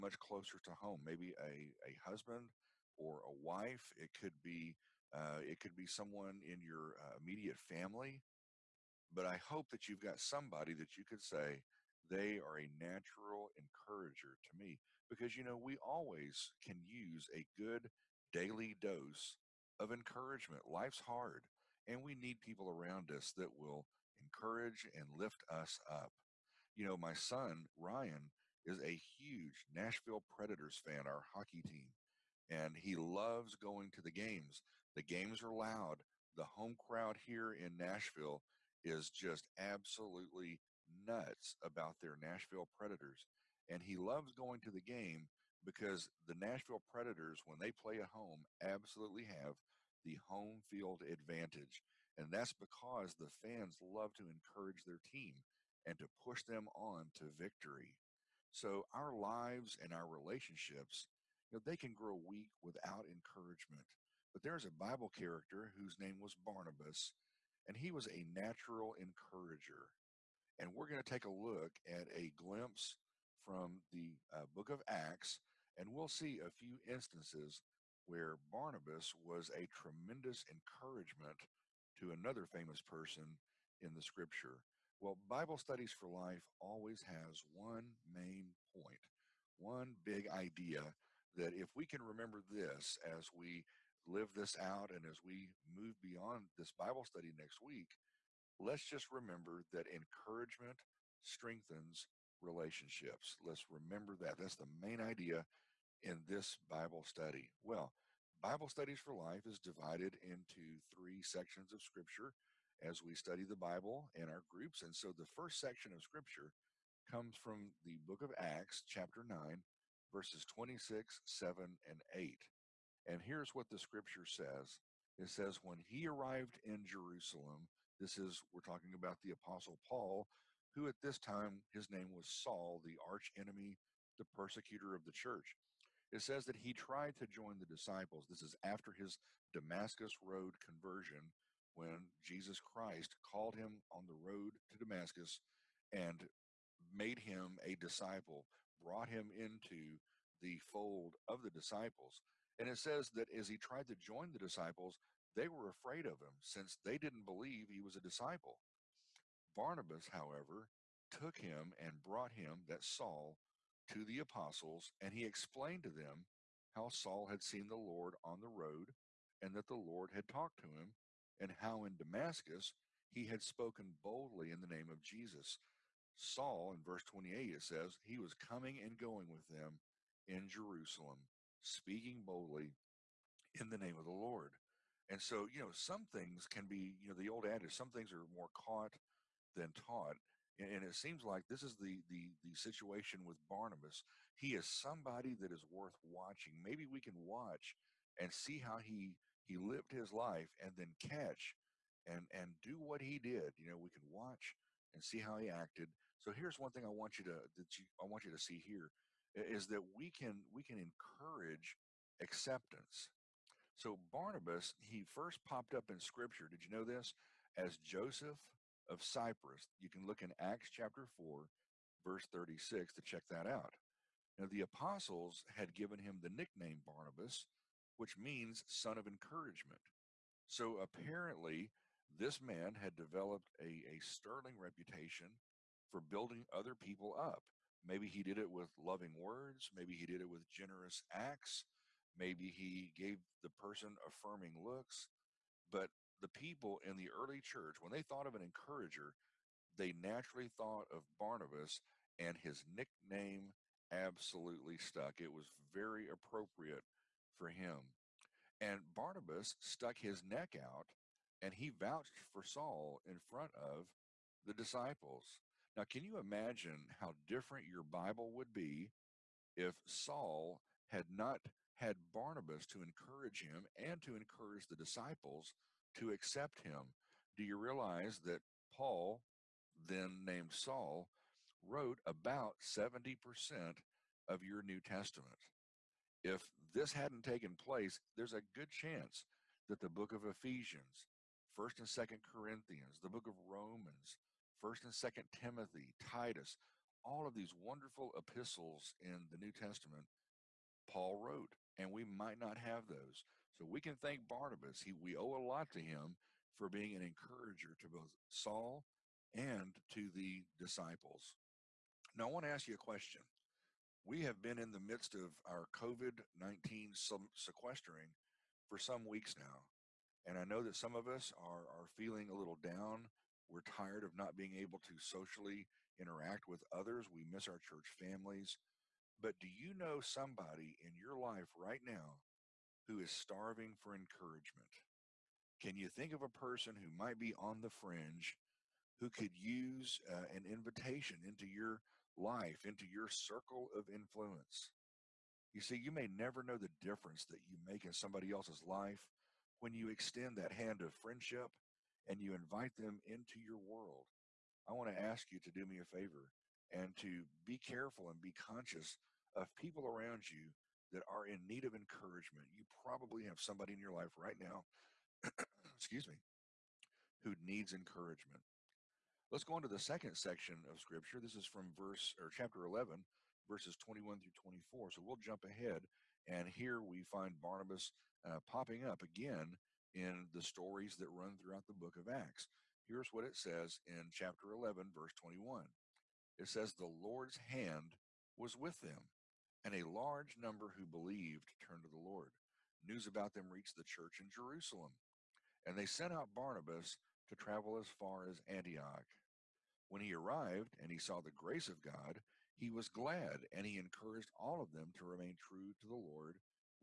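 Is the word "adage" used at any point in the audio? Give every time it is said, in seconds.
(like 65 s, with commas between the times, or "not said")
187 s.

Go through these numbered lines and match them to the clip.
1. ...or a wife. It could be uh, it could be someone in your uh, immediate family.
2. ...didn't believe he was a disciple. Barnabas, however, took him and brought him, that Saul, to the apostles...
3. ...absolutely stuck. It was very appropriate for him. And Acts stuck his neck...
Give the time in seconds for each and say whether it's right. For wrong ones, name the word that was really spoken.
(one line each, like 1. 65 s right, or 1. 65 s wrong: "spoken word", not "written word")
1. 2 s right
2. 156 s right
3. 253 s wrong: "Barnabas", not "Acts".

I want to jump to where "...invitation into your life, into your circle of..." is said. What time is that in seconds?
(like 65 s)
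340 s.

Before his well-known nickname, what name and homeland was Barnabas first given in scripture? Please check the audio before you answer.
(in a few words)
Joseph of Cyprus.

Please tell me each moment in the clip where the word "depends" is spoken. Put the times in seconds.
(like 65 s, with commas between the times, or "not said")
not said.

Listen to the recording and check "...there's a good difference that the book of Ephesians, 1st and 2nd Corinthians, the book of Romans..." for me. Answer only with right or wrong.
wrong.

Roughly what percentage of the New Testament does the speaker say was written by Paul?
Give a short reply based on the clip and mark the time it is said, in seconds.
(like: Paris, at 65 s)
70%, at 282 s.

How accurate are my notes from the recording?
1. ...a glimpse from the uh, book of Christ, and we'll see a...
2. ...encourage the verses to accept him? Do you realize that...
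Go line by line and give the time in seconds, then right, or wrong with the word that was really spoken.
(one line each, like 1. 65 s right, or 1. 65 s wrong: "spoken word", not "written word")
1. 72 s wrong: "Acts", not "Christ"
2. 274 s wrong: "disciples", not "verses".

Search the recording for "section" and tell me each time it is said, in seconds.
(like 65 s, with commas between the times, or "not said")
111 s, 115 s, 370 s.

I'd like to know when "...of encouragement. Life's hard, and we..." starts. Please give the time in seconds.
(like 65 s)
19 s.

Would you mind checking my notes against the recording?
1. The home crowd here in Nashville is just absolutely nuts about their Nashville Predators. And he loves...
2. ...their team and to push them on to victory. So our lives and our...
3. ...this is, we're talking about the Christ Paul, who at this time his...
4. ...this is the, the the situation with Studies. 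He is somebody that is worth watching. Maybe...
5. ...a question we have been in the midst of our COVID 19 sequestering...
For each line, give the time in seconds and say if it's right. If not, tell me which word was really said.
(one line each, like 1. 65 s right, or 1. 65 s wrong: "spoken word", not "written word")
1. 36 s right
2. 54 s right
3. 128 s wrong: "Apostle", not "Christ"
4. 191 s wrong: "Barnabas", not "Studies"
5. 312 s right.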